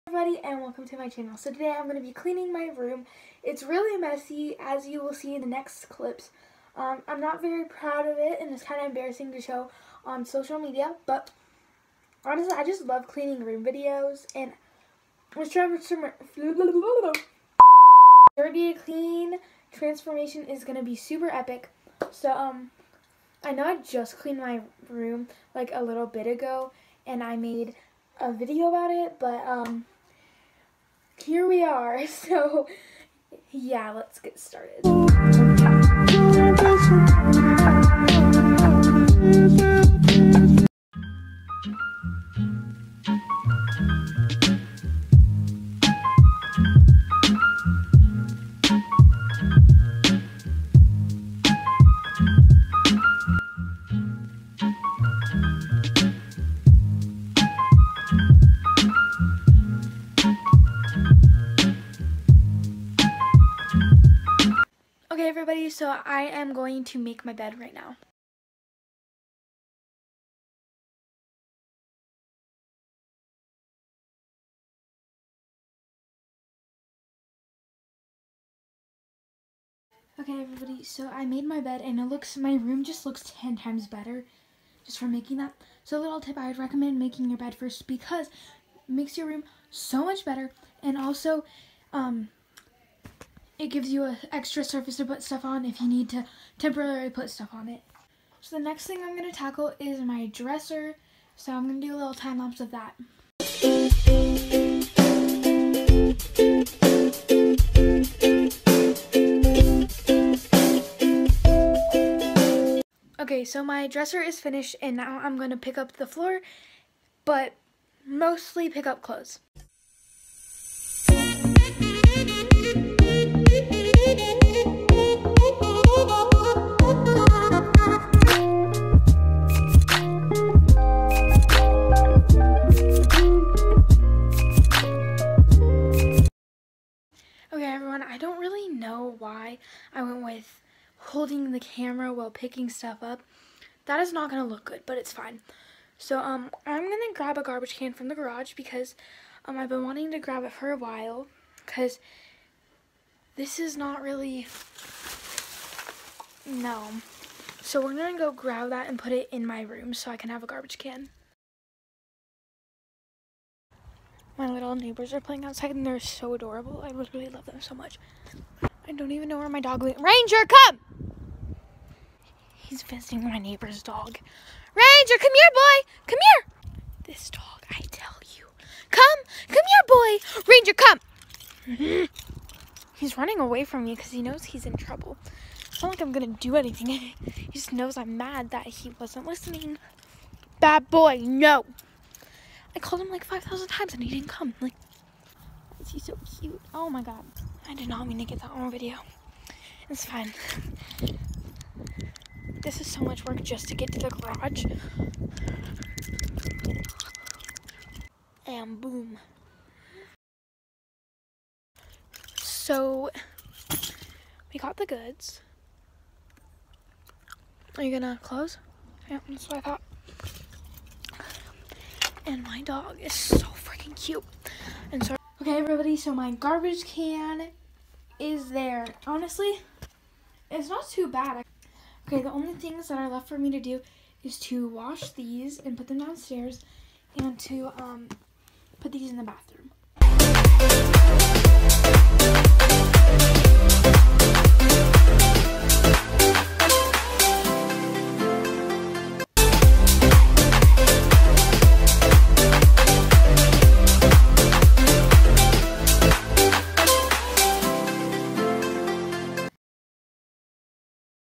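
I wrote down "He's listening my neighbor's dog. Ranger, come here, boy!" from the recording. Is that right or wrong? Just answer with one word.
wrong.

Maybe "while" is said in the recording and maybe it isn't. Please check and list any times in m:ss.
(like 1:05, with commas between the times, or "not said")
2:22, 2:30.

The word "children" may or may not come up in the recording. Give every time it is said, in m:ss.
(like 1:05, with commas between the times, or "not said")
not said.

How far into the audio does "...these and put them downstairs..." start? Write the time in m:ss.
3:55.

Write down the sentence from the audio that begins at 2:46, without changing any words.
I literally love them so much.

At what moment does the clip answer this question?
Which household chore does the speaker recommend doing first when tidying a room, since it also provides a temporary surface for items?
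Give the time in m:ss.
1:26.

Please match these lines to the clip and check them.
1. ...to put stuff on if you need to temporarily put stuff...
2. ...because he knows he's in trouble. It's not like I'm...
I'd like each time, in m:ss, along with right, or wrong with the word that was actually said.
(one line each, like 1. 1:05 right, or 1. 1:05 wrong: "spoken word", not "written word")
1. 1:34 right
2. 3:03 right.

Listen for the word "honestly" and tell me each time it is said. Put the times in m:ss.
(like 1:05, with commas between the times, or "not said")
0:12, 3:49.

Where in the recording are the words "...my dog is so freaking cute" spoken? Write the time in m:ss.
3:42.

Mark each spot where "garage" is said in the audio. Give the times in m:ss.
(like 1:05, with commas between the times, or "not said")
2:28, 3:24.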